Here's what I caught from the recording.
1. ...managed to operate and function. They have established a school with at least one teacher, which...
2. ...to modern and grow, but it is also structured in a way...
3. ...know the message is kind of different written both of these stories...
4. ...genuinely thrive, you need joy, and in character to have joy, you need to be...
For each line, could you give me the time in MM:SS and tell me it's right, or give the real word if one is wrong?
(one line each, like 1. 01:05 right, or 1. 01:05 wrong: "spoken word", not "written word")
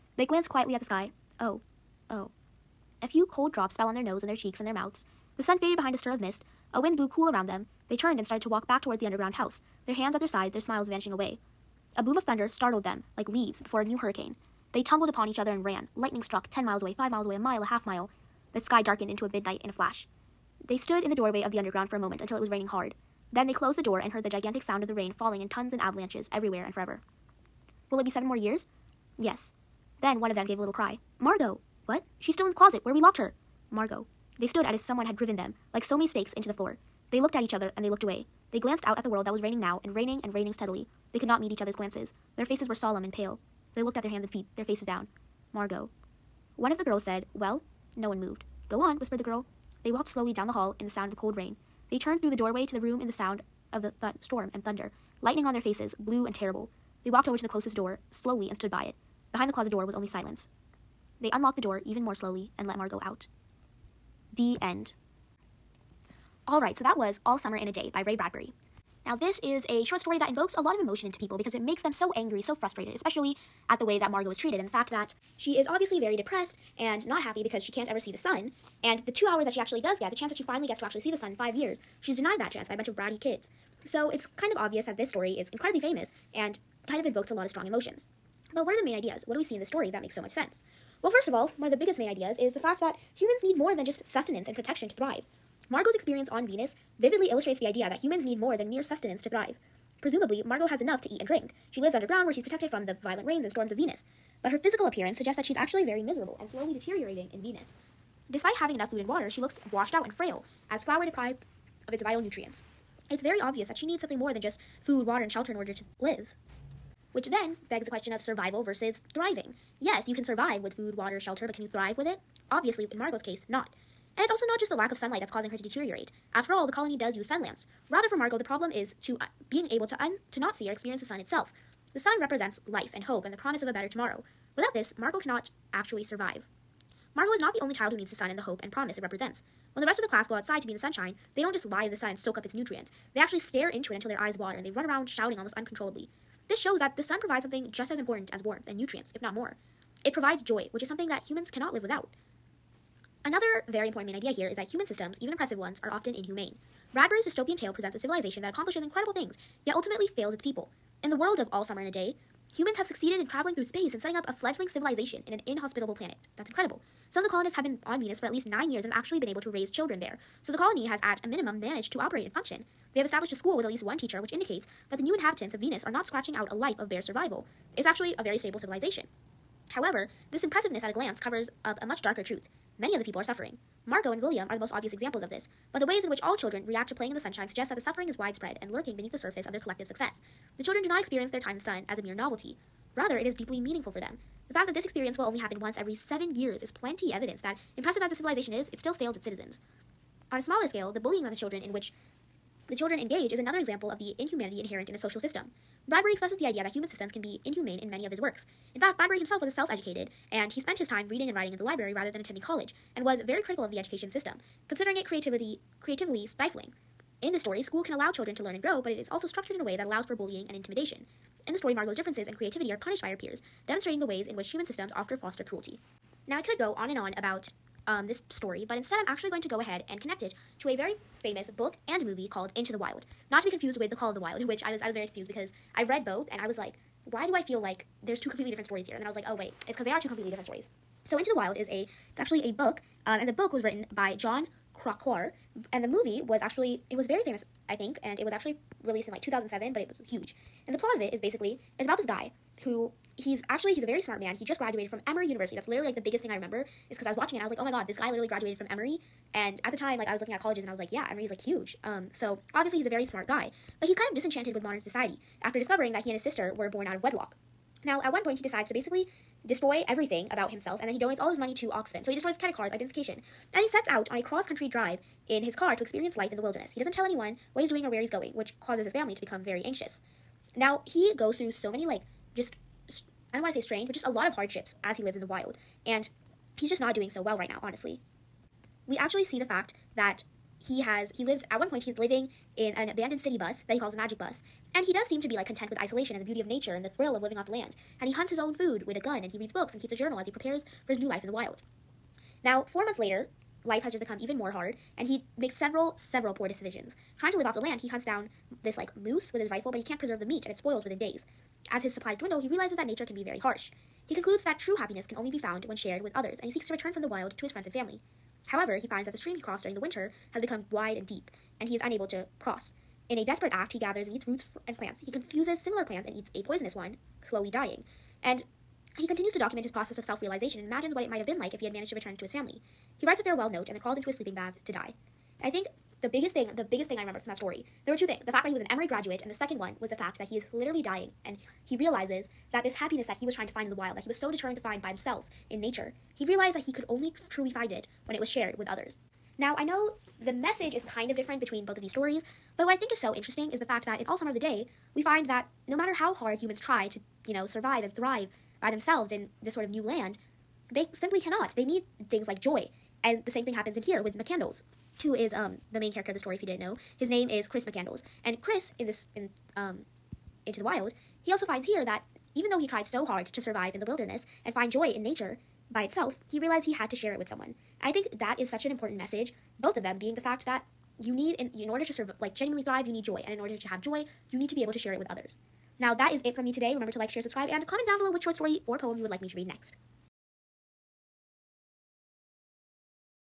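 1. 02:51 right
2. 03:38 wrong: "learn", not "modern"
3. 05:49 wrong: "between", not "written"
4. 06:22 wrong: "order", not "character".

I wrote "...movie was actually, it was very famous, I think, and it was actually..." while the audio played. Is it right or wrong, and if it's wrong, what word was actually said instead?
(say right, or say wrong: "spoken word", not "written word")
right.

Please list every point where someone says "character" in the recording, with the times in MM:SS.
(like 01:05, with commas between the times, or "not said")
06:05.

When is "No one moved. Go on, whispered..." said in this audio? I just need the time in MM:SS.
00:47.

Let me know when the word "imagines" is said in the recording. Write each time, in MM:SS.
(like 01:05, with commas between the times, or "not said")
05:30.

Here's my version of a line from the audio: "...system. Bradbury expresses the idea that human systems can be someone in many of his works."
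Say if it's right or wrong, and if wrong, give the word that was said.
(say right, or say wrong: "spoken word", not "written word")
wrong: "inhumane", not "someone".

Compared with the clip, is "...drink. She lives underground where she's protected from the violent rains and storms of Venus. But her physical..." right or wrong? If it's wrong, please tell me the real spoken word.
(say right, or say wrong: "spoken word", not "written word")
right.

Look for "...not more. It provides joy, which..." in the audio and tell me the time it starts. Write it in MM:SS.
02:29.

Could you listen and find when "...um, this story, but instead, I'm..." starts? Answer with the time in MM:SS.
03:47.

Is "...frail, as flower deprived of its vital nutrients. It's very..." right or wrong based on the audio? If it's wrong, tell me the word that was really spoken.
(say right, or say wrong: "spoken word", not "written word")
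right.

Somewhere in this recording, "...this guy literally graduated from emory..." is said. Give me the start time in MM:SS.
04:17.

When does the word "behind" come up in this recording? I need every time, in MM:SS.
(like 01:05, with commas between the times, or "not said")
00:05, 00:59.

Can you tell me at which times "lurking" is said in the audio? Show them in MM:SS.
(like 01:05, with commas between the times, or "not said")
03:08.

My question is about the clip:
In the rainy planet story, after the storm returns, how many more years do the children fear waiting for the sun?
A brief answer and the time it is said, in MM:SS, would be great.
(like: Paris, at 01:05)
7, at 00:28.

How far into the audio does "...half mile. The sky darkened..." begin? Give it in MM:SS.
00:17.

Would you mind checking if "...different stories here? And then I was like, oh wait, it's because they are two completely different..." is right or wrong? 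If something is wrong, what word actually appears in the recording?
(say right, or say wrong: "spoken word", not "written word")
right.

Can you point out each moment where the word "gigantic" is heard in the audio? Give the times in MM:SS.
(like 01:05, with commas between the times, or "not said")
00:24.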